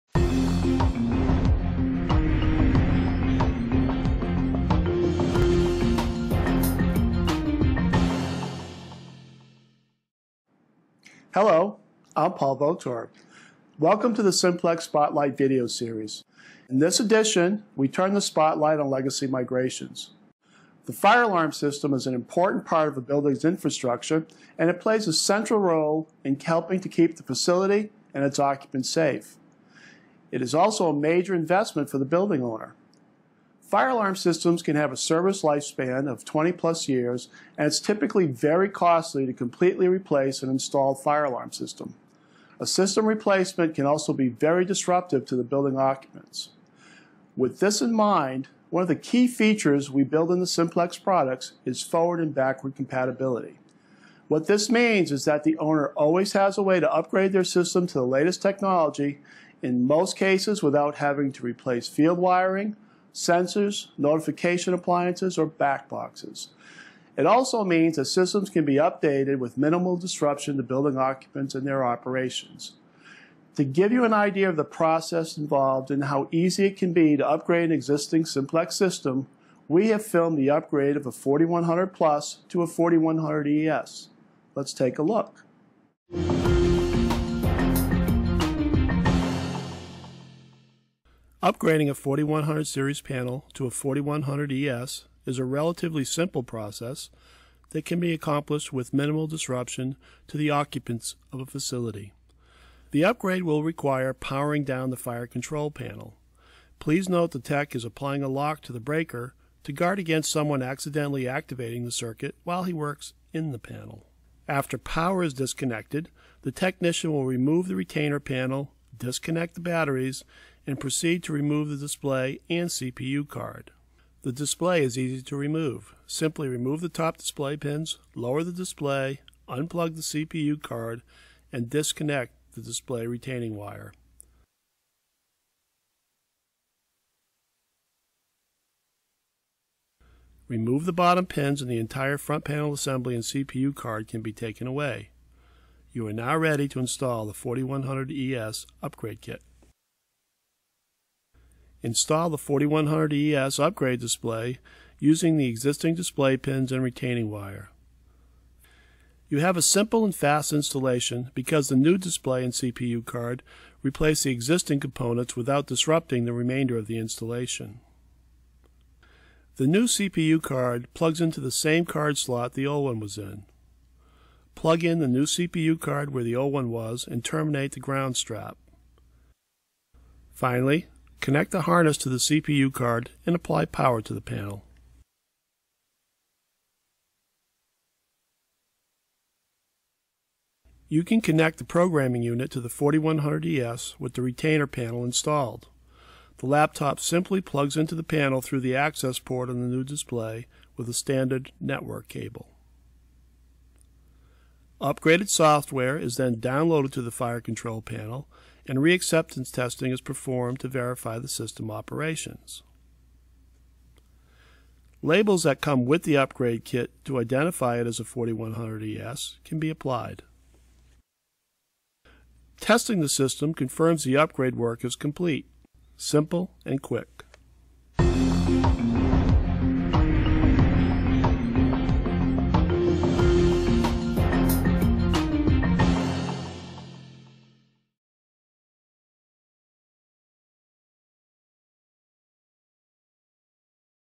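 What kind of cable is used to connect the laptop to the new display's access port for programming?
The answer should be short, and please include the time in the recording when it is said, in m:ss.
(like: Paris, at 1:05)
Standard network cable, at 3:20.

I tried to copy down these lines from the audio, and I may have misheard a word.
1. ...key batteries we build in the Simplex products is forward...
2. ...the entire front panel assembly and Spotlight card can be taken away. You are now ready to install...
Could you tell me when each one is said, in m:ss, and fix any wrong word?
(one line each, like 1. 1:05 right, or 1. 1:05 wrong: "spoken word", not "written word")
1. 0:48 wrong: "features", not "batteries"
2. 2:21 wrong: "CPU", not "Spotlight".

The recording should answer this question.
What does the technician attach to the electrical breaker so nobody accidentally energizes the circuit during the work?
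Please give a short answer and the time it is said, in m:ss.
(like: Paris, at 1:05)
A lock, at 1:48.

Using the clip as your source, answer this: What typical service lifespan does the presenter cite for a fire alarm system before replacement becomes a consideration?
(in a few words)
20 plus years.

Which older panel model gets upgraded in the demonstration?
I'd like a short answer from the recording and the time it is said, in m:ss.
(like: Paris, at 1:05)
4100 Plus, at 1:21.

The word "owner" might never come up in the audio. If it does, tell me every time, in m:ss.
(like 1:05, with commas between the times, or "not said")
0:32, 0:55.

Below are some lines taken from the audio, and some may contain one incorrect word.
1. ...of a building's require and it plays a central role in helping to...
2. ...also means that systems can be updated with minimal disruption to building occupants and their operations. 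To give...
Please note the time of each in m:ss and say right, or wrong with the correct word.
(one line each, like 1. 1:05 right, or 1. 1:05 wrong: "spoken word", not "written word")
1. 0:22 wrong: "infrastructure", not "require"
2. 1:07 right.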